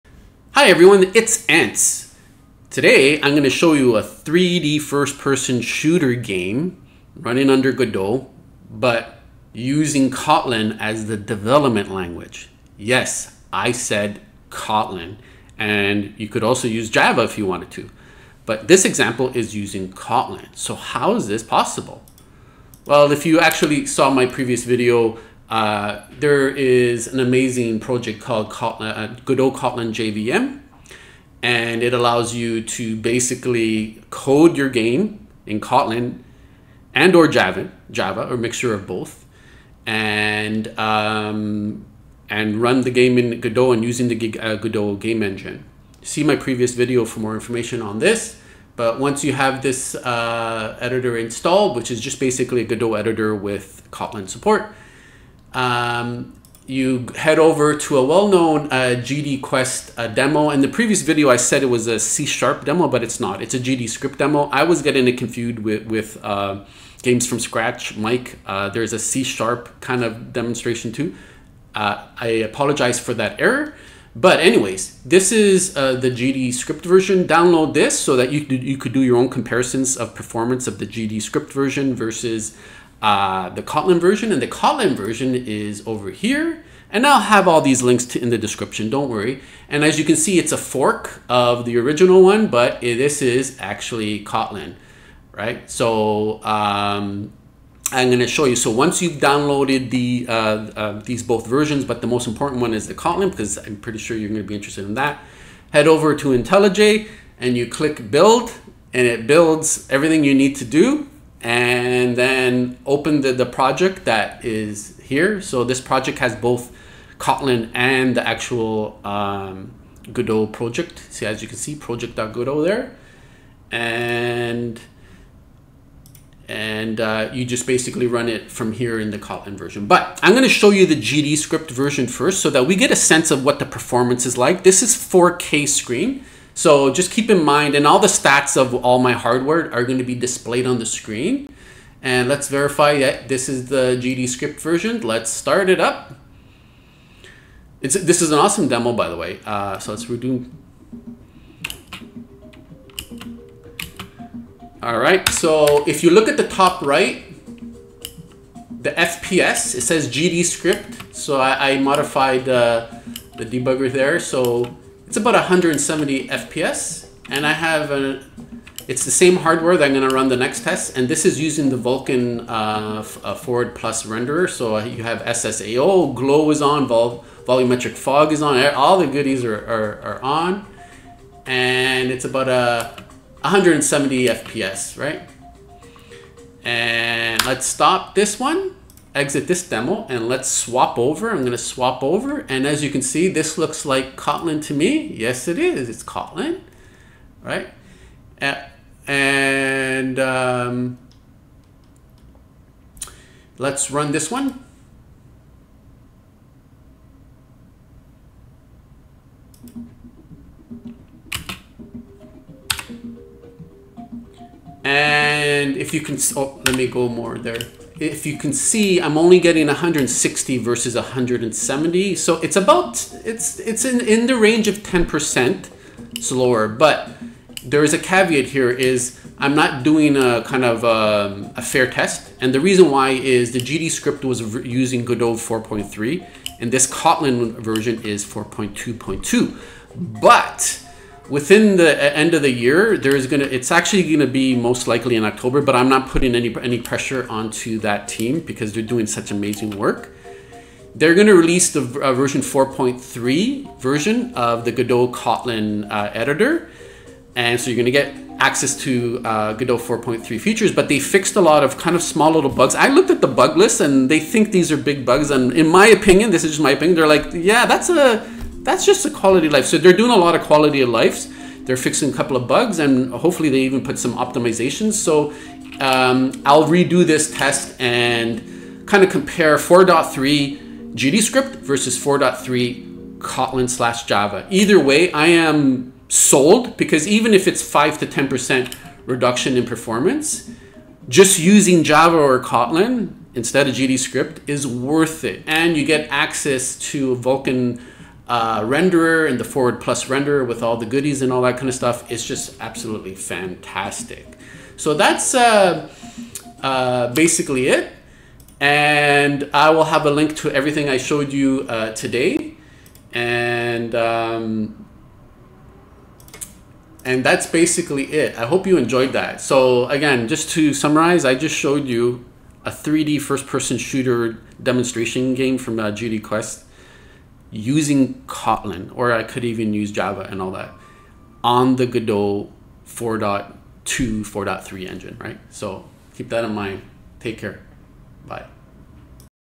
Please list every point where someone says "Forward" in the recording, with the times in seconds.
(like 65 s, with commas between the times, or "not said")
173 s, 299 s.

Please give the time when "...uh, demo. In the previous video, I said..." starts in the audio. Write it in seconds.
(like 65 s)
59 s.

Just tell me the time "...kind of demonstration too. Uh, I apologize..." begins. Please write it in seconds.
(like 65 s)
69 s.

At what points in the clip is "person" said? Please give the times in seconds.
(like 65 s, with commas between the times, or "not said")
5 s, 323 s.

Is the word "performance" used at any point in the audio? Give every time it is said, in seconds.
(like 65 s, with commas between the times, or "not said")
80 s, 133 s, 289 s.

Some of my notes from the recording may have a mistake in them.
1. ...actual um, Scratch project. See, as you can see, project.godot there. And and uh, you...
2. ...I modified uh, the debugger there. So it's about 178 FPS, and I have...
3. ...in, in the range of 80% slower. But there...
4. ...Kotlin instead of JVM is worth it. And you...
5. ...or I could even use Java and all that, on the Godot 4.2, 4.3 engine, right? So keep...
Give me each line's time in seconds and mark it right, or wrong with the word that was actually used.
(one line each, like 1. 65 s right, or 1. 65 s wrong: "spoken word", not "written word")
1. 118 s wrong: "Godot", not "Scratch"
2. 161 s wrong: "170", not "178"
3. 223 s wrong: "10", not "80"
4. 292 s wrong: "GDScript", not "JVM"
5. 328 s right.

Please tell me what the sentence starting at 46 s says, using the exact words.
See my previous video for more information on this.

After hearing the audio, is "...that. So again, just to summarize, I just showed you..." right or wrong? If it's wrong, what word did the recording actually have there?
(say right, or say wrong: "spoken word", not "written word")
right.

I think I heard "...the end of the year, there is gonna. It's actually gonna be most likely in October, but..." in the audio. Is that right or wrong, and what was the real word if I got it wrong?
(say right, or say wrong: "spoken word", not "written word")
right.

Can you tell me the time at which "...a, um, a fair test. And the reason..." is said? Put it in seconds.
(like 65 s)
230 s.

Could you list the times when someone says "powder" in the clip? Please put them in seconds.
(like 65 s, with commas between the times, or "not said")
not said.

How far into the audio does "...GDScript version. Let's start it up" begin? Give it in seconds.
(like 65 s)
144 s.